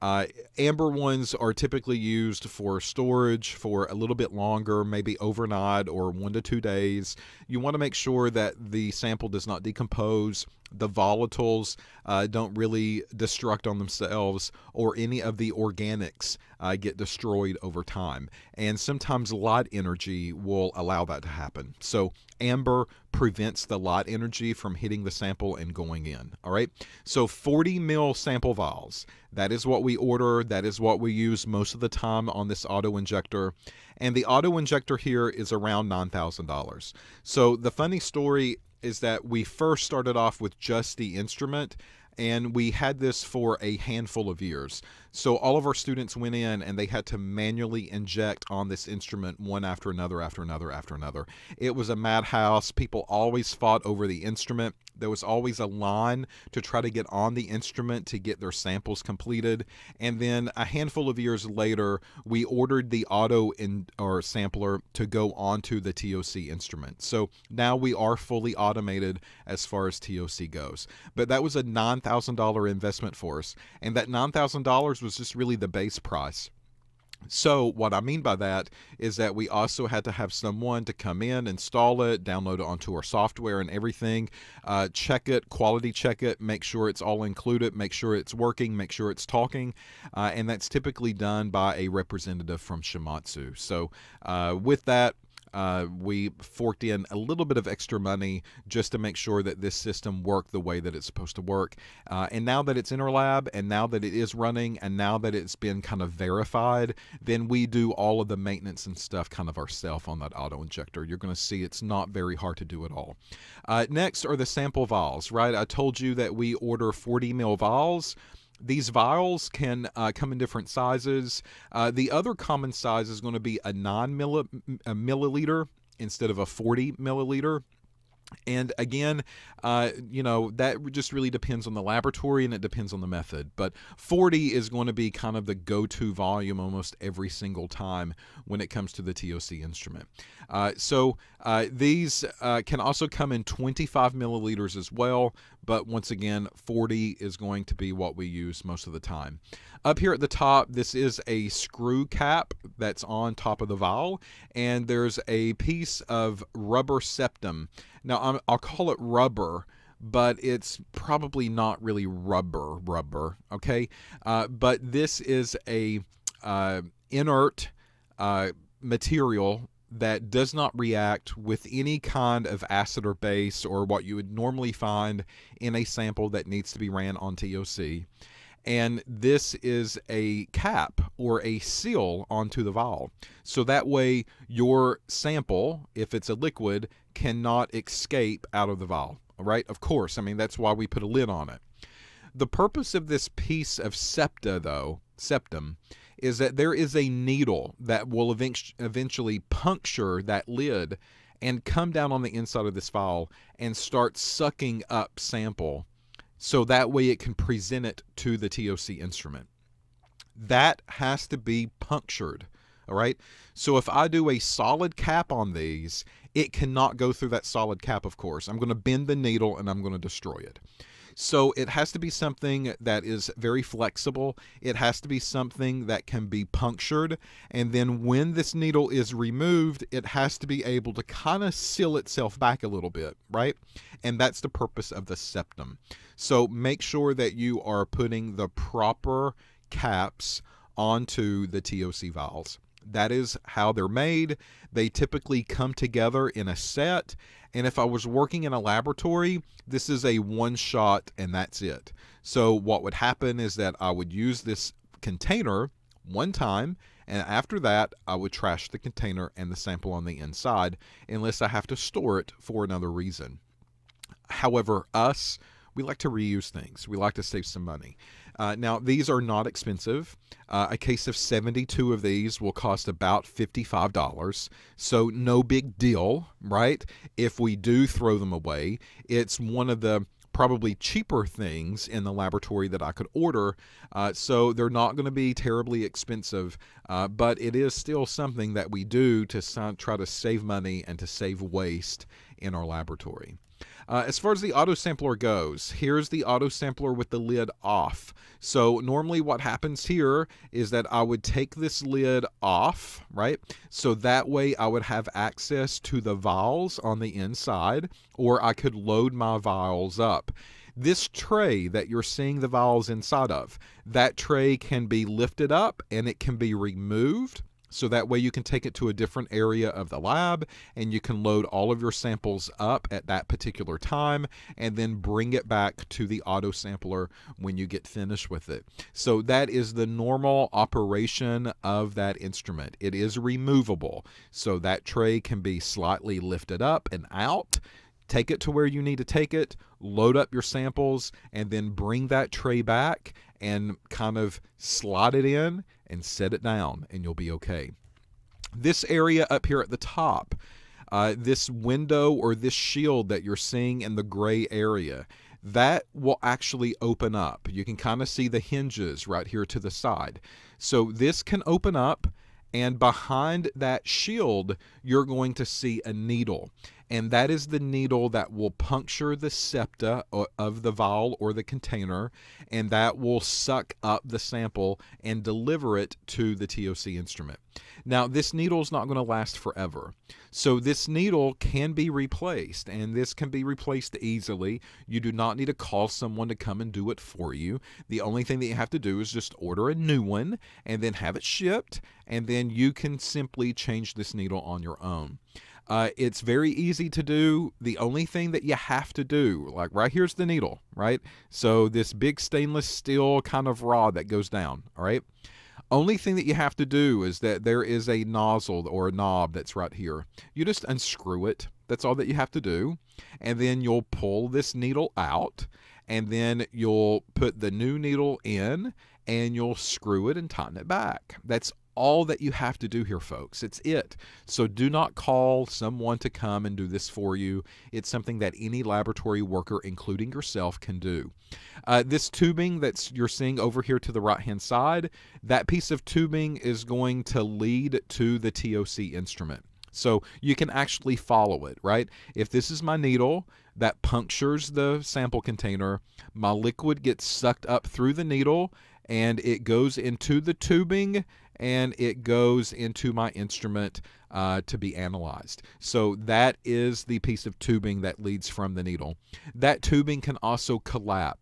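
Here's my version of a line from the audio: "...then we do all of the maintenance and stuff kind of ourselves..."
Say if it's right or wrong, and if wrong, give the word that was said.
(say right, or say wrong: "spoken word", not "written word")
right.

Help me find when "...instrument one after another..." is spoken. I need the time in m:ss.
0:48.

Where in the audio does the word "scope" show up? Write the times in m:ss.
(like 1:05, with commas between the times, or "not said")
not said.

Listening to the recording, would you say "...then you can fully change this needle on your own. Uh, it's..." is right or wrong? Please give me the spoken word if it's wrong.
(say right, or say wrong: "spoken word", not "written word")
wrong: "simply", not "fully".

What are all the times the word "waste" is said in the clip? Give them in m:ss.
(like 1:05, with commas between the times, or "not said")
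4:51.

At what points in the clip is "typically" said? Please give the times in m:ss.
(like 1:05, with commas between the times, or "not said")
0:01, 1:30, 4:04.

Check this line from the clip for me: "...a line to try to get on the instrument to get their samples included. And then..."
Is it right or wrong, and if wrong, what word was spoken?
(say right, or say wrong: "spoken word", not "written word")
wrong: "completed", not "included".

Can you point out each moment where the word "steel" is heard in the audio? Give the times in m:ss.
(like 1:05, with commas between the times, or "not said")
6:42.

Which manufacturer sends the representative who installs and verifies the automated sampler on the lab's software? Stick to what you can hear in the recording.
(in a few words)
Shimadzu.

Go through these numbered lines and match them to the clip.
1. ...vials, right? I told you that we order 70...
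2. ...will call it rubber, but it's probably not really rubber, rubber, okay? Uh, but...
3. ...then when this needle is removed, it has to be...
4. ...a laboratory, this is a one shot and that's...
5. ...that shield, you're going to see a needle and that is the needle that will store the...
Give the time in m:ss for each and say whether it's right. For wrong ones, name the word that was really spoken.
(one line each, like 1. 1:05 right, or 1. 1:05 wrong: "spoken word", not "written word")
1. 1:54 wrong: "40", not "70"
2. 2:38 right
3. 3:47 right
4. 4:08 right
5. 6:03 wrong: "puncture", not "store".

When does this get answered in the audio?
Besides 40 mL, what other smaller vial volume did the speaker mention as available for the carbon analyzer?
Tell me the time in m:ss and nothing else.
2:23.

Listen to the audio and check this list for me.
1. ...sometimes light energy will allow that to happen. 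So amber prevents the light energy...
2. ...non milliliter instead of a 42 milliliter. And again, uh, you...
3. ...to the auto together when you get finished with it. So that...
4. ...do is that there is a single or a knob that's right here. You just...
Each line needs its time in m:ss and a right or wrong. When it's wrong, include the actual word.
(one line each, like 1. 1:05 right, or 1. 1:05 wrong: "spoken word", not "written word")
1. 0:18 right
2. 2:03 wrong: "40", not "42"
3. 5:25 wrong: "sampler", not "together"
4. 6:46 wrong: "nozzle", not "single".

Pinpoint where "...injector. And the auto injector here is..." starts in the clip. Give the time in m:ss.
0:32.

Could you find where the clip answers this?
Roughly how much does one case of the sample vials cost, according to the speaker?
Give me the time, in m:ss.
4:33.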